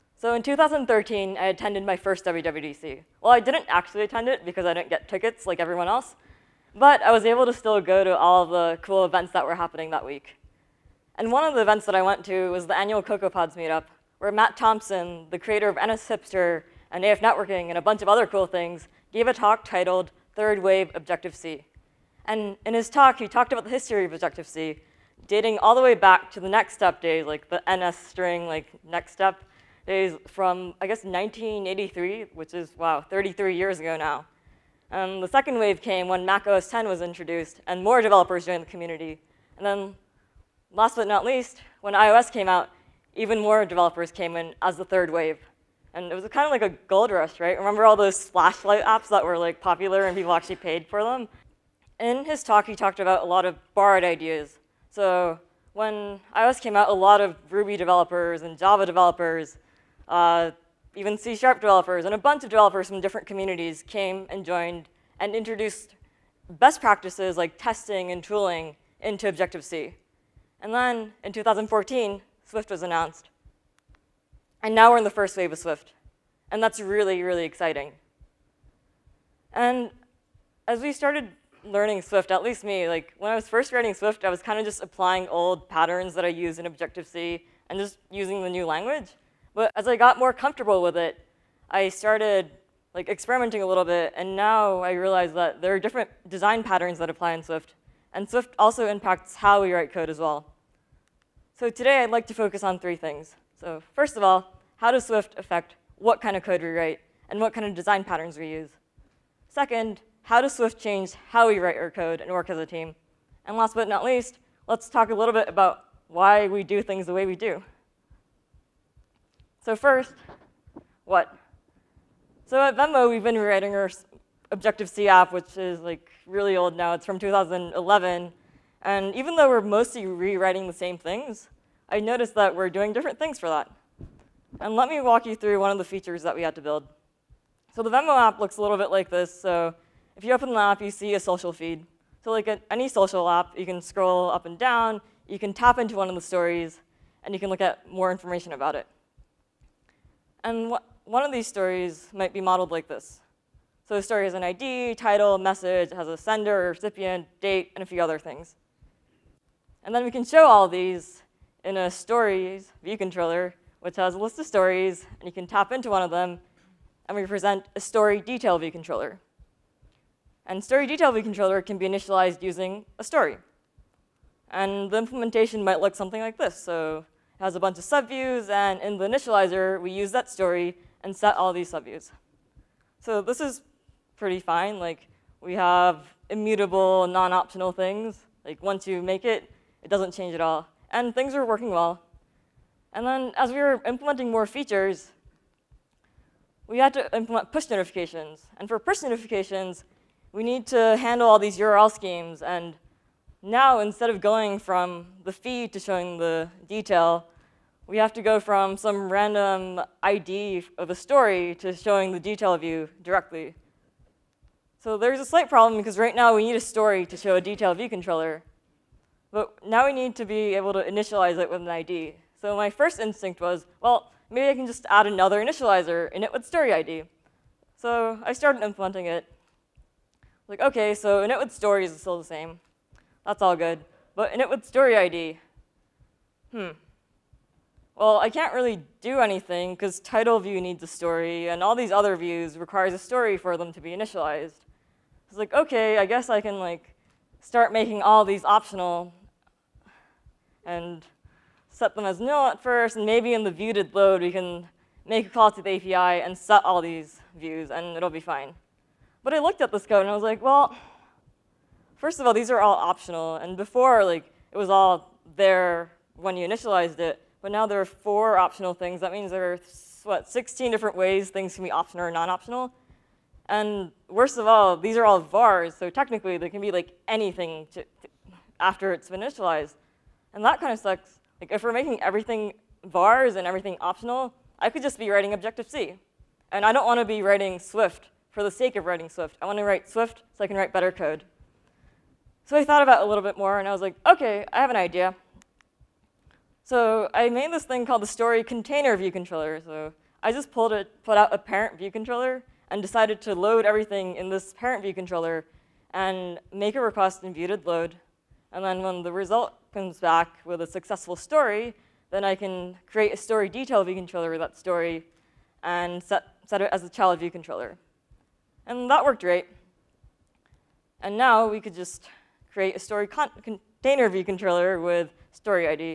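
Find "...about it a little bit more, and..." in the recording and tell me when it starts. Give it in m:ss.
4:52.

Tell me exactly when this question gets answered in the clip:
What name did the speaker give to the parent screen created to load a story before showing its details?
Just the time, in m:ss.
4:58.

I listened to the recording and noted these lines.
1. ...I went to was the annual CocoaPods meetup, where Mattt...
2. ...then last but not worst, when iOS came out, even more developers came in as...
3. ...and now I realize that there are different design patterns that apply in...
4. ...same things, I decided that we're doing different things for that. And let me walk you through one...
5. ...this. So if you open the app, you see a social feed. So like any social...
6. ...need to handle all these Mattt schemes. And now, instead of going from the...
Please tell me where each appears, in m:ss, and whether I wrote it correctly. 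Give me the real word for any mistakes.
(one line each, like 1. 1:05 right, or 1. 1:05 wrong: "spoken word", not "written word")
1. 0:11 right
2. 0:39 wrong: "least", not "worst"
3. 1:34 right
4. 2:10 wrong: "noticed", not "decided"
5. 2:19 right
6. 3:20 wrong: "URL", not "Mattt".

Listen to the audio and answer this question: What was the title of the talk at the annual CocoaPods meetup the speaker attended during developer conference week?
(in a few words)
Third Wave Objective-C.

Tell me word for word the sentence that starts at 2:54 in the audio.
And the implementation might look something like this.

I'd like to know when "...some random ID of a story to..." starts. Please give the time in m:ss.
3:28.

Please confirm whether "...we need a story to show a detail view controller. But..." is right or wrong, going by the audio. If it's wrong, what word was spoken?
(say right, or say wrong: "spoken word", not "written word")
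right.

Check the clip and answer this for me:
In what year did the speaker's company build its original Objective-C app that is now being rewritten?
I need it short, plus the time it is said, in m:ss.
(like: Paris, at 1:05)
2011, at 2:07.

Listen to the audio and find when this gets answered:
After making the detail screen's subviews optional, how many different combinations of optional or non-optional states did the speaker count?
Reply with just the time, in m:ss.
4:30.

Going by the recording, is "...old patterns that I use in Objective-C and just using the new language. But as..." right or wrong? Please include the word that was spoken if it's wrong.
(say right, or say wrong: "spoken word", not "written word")
right.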